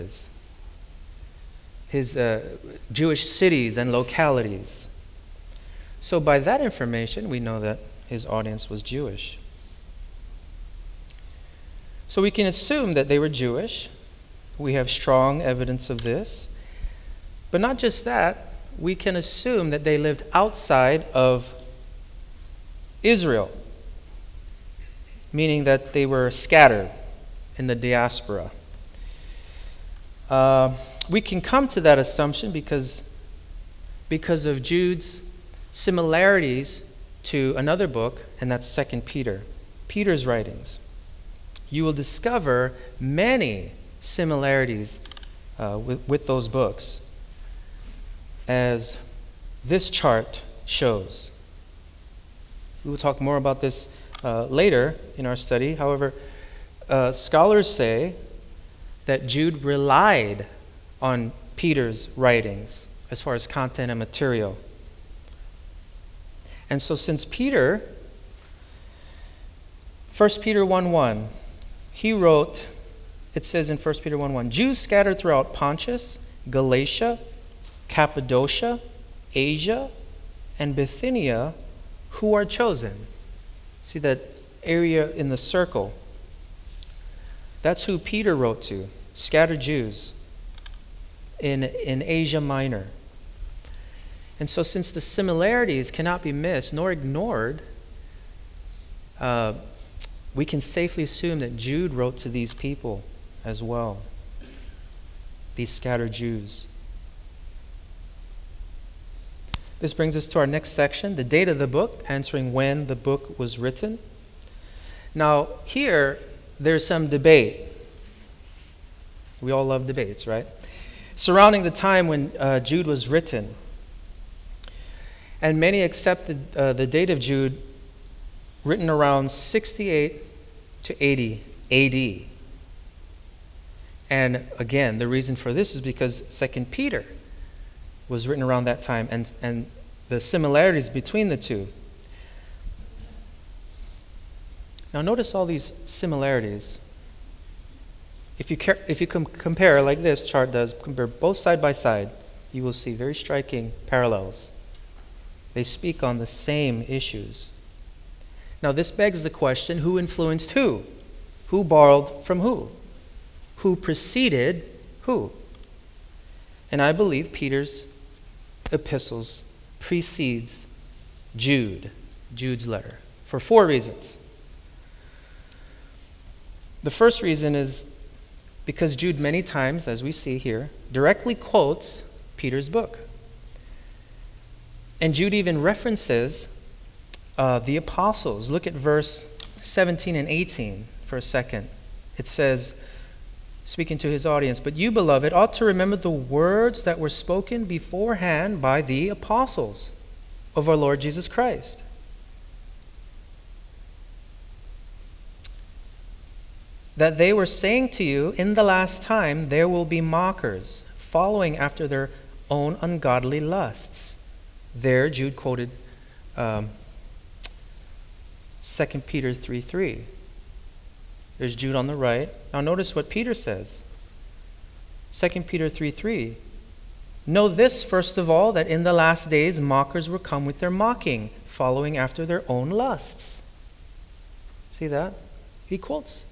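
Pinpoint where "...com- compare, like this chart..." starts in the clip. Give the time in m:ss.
2:29.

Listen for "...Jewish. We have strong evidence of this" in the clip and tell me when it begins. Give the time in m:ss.
0:13.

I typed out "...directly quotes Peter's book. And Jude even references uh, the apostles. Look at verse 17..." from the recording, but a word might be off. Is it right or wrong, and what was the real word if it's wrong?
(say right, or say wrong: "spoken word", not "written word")
right.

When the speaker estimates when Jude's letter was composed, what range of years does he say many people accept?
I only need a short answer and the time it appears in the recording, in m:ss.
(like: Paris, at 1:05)
68 to 80 AD, at 2:09.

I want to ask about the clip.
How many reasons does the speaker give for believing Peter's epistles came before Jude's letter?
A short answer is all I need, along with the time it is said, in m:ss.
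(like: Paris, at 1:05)
4, at 2:53.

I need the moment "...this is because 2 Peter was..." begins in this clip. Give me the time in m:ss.
2:15.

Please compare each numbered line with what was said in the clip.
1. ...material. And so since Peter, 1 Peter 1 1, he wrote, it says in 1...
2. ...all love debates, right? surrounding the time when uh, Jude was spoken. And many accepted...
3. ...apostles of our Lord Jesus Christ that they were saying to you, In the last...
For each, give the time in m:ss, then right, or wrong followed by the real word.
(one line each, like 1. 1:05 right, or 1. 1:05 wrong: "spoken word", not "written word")
1. 1:03 right
2. 1:59 wrong: "written", not "spoken"
3. 3:19 right.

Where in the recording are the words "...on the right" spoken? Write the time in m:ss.
3:41.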